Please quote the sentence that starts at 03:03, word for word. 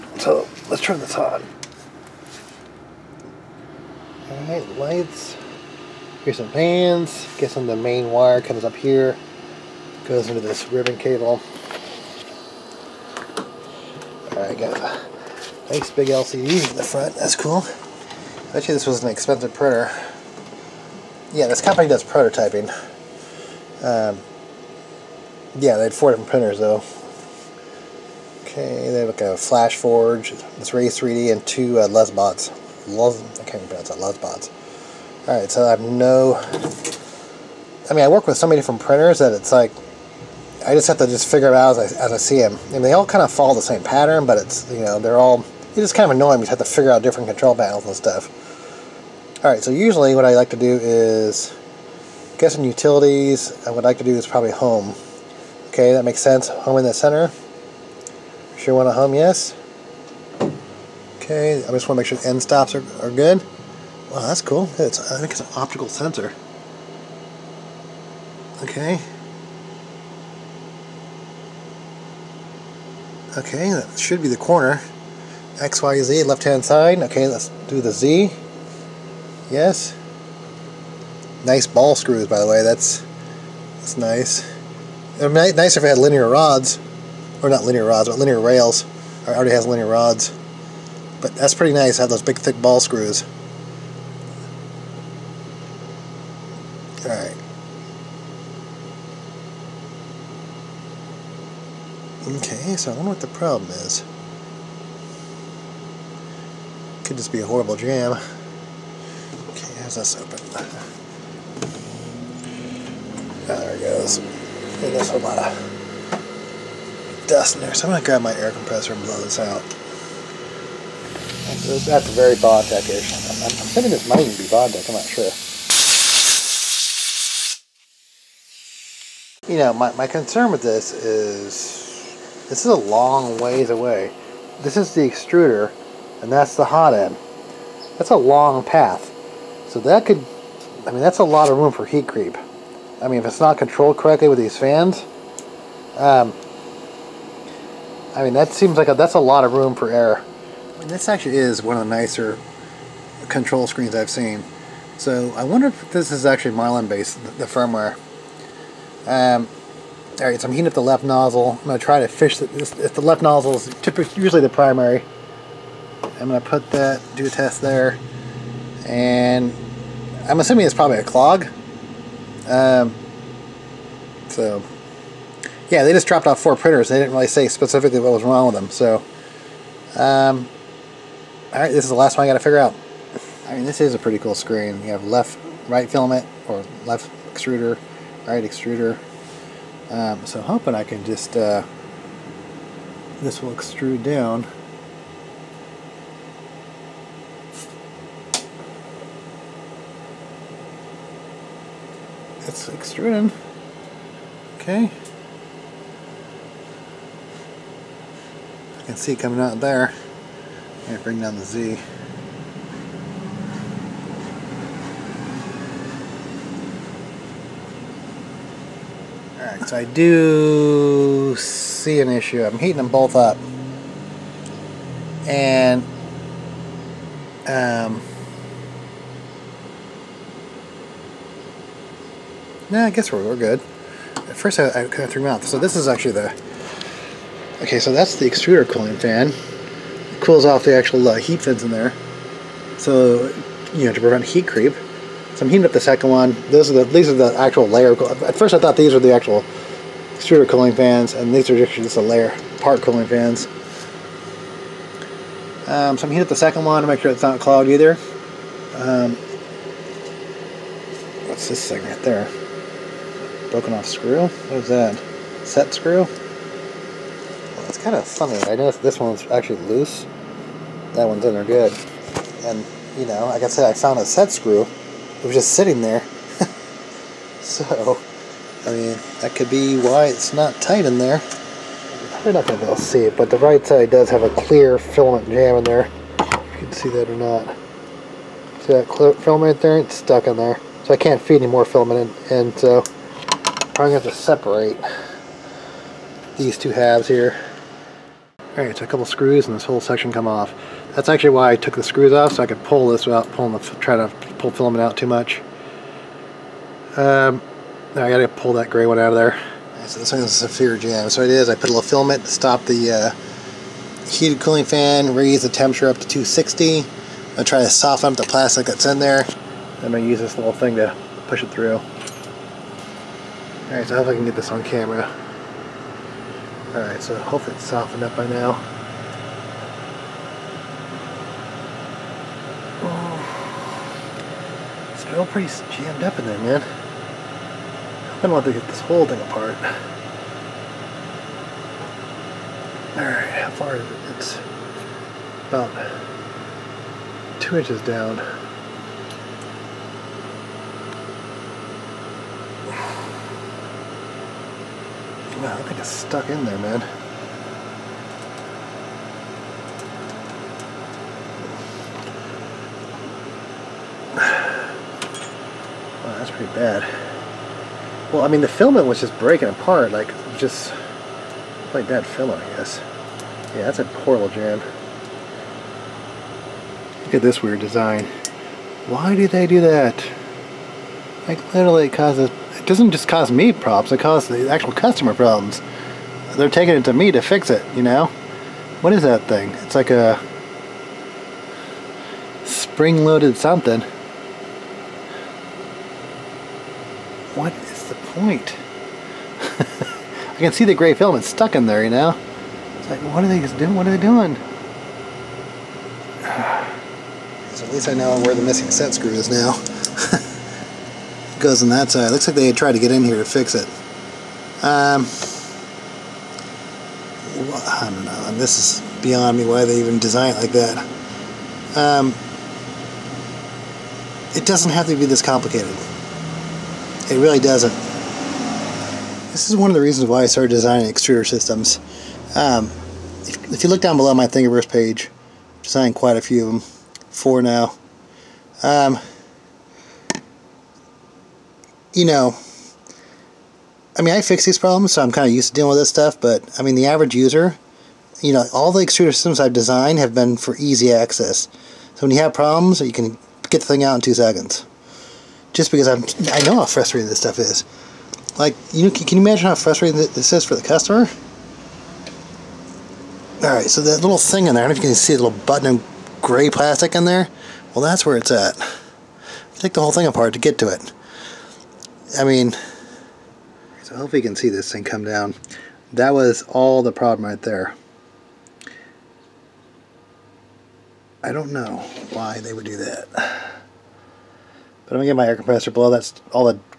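I mean, this is a pretty cool screen.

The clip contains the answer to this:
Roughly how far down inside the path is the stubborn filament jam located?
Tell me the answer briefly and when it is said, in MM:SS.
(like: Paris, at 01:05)
two inches, at 05:47.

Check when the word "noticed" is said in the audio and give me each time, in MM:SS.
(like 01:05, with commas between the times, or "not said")
04:28.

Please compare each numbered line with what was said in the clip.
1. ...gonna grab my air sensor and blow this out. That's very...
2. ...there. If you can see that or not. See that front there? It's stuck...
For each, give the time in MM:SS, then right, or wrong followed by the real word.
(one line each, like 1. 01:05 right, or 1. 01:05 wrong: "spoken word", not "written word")
1. 01:57 wrong: "compressor", not "sensor"
2. 04:45 wrong: "filament", not "front".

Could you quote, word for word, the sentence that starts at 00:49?
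Alright, so usually what I like to do is, get some utilities, I would like to do is probably home.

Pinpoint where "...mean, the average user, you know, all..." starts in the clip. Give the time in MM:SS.
07:26.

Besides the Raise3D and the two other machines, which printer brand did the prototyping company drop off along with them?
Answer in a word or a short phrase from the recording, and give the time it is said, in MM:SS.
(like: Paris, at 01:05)
Flash Forge, at 00:29.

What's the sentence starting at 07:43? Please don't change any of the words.
Alright, so that little thing in there, I don't know if you can see the little button of gray plastic in there.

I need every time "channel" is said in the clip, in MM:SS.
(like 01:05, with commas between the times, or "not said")
not said.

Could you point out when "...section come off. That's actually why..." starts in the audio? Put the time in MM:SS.
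04:59.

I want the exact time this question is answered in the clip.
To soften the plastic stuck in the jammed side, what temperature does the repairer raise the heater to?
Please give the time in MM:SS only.
05:16.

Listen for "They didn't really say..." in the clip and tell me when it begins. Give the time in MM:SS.
02:56.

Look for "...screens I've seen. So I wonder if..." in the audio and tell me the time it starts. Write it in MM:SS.
02:33.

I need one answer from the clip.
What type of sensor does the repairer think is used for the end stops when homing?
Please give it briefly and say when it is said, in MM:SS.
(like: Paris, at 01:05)
optical sensor, at 01:05.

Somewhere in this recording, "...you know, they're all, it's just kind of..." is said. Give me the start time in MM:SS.
00:44.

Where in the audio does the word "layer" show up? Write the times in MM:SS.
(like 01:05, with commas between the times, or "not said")
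04:07, 04:12.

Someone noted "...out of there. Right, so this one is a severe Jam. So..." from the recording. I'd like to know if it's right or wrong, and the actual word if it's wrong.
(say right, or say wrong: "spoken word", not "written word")
right.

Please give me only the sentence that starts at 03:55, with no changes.
So this is actually the, okay, so that's the extruder cooling fan cools off the actual uh, heat fins in there.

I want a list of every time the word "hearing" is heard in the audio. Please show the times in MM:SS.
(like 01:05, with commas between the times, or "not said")
not said.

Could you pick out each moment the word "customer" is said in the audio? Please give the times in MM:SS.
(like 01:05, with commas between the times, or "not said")
06:24, 07:40.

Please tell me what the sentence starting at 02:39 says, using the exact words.
Um, Alright, so I'm heating up the left nozzle.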